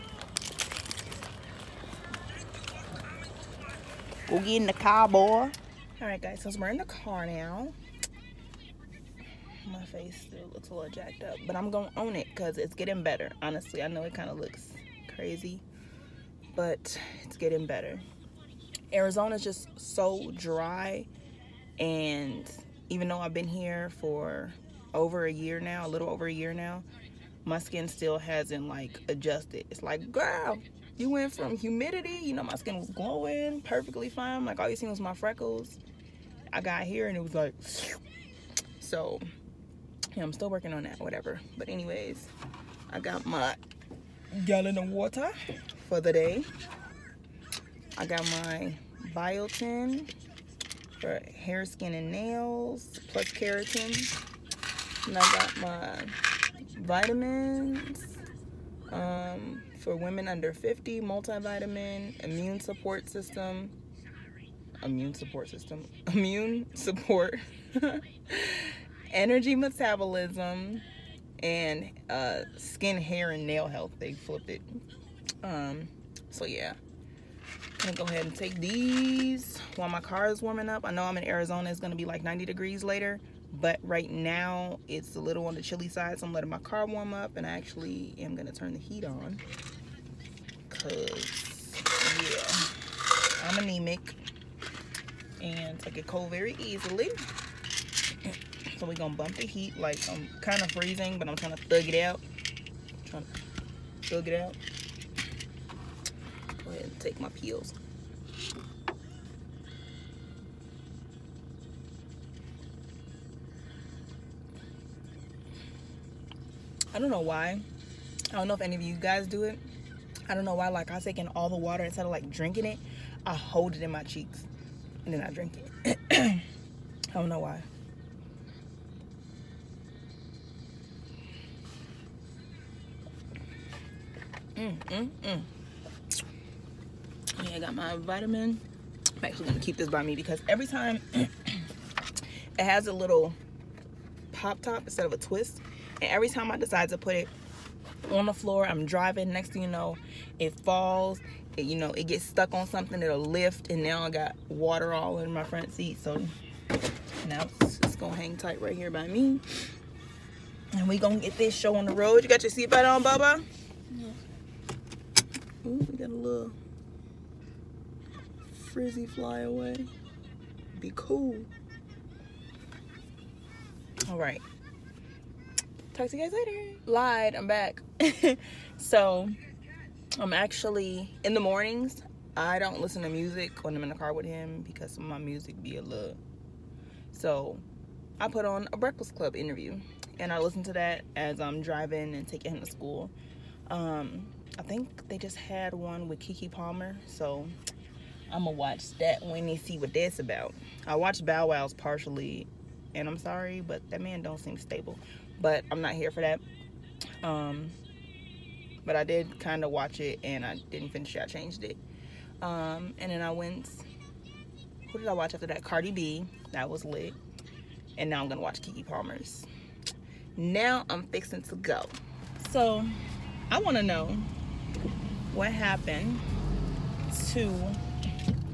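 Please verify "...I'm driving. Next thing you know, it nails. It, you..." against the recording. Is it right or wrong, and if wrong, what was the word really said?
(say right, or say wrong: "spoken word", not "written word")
wrong: "falls", not "nails".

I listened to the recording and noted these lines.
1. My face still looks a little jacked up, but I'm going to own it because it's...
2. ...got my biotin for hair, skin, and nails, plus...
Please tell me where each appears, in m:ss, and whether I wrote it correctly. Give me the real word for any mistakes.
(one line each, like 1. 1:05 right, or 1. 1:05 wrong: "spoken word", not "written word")
1. 0:09 right
2. 0:48 right.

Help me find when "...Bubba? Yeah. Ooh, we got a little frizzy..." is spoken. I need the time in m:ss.
2:43.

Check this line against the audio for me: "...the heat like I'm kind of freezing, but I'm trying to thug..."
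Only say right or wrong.
right.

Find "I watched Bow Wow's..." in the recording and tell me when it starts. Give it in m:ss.
3:20.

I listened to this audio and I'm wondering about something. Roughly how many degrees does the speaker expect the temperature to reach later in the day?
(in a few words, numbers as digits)
90.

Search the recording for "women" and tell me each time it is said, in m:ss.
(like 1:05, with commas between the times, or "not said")
0:59.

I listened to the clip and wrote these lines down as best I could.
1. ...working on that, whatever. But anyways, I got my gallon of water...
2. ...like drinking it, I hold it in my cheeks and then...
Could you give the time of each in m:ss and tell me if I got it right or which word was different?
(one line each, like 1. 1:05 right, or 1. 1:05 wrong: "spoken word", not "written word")
1. 0:40 right
2. 2:02 right.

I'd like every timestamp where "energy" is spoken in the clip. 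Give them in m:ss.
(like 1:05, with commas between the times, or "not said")
1:09.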